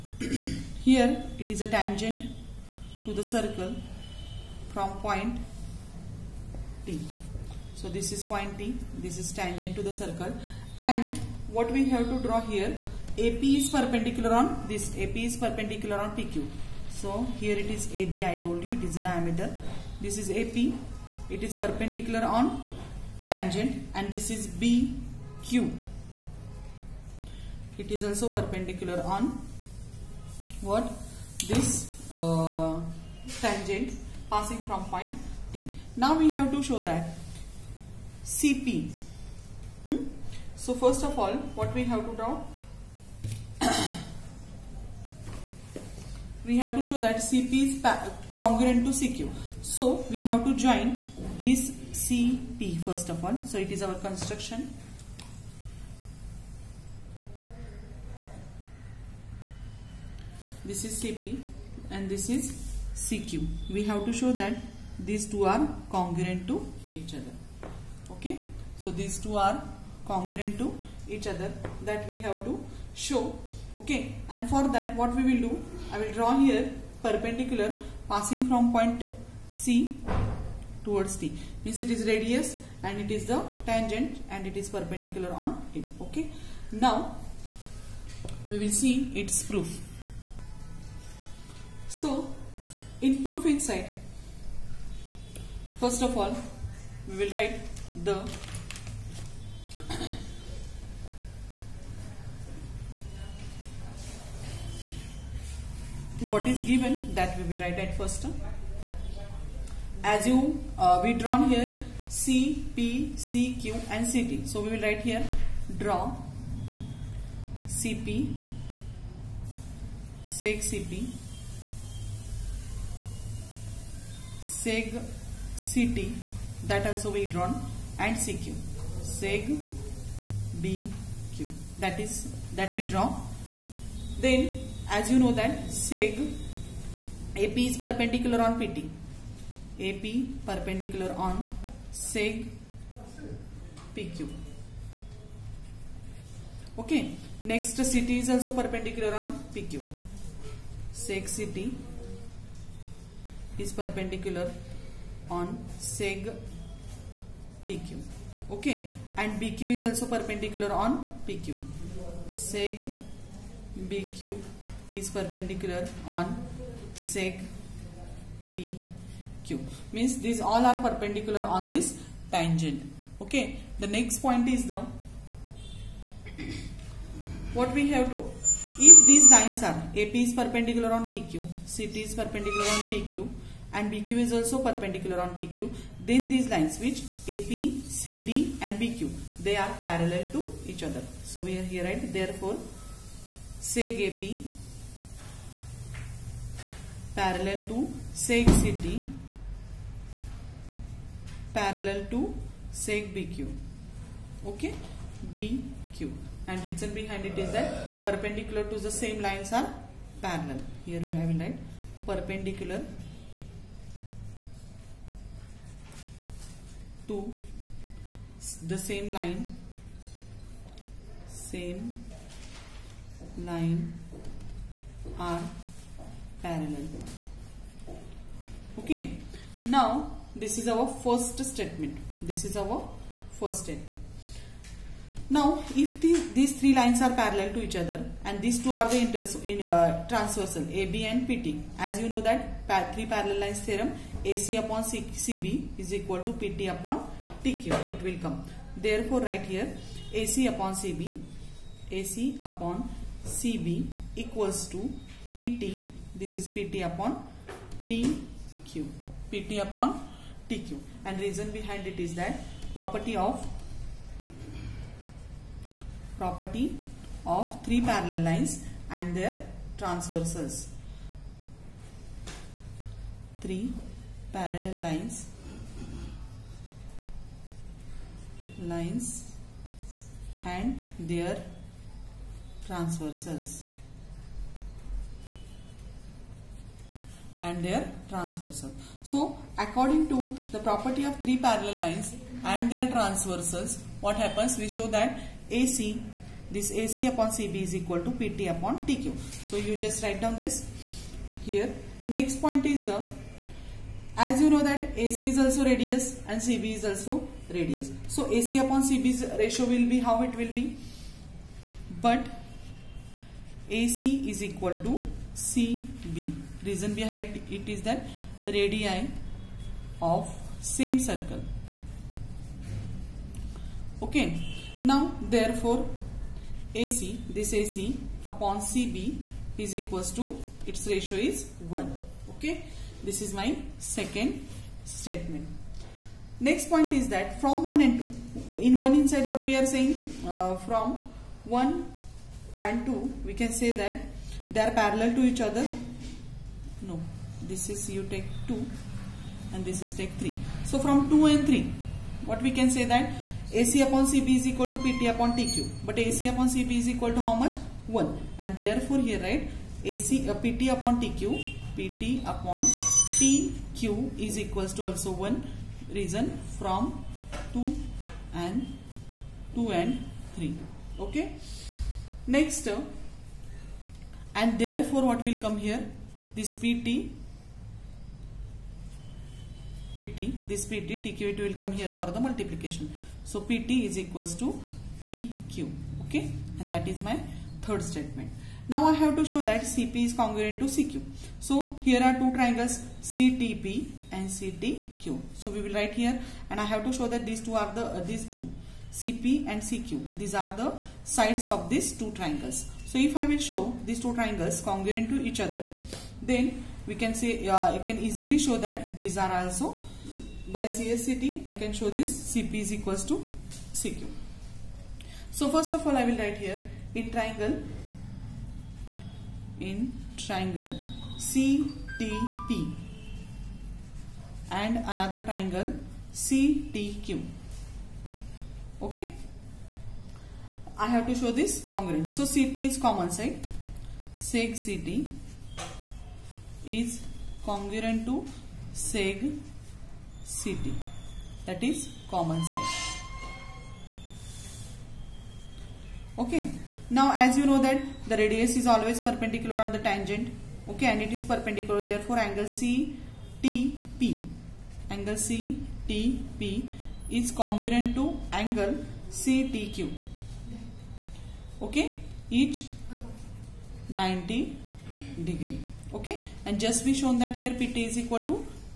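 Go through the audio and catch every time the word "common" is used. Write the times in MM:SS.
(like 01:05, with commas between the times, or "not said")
07:12, 07:22.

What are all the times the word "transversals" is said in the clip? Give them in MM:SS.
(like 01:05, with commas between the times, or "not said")
04:00, 04:29, 04:42, 04:48, 04:52.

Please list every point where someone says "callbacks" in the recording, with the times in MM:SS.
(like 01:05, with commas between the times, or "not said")
not said.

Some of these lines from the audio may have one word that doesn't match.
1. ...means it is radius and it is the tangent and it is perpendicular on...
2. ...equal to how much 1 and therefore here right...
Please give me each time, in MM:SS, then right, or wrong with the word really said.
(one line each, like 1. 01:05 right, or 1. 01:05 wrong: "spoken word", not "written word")
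1. 01:21 right
2. 05:56 right.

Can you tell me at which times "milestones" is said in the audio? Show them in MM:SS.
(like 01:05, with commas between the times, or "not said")
not said.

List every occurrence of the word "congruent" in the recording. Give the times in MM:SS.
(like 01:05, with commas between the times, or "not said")
00:48, 01:05, 01:10, 06:30, 06:44, 07:11, 07:17, 07:37.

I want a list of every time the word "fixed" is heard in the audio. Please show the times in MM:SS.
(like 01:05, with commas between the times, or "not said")
not said.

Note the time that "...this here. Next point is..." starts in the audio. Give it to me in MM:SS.
05:00.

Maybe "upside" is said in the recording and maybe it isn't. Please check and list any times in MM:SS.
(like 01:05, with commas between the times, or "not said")
not said.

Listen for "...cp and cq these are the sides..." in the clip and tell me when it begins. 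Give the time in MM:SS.
06:38.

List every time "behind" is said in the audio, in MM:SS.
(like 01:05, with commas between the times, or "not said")
03:26, 04:21, 05:16.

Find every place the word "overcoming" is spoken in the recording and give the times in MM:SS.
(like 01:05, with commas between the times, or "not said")
not said.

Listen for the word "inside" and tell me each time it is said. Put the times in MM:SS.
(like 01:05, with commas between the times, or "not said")
01:33, 05:39.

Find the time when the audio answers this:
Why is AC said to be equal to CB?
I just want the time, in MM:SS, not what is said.
05:18.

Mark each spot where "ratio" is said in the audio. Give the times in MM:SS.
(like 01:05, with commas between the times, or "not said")
05:09, 05:30.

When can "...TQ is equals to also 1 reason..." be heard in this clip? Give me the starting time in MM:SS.
06:02.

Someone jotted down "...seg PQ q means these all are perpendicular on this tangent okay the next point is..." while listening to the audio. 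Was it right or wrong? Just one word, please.
right.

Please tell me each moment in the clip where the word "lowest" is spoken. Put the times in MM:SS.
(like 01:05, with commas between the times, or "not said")
not said.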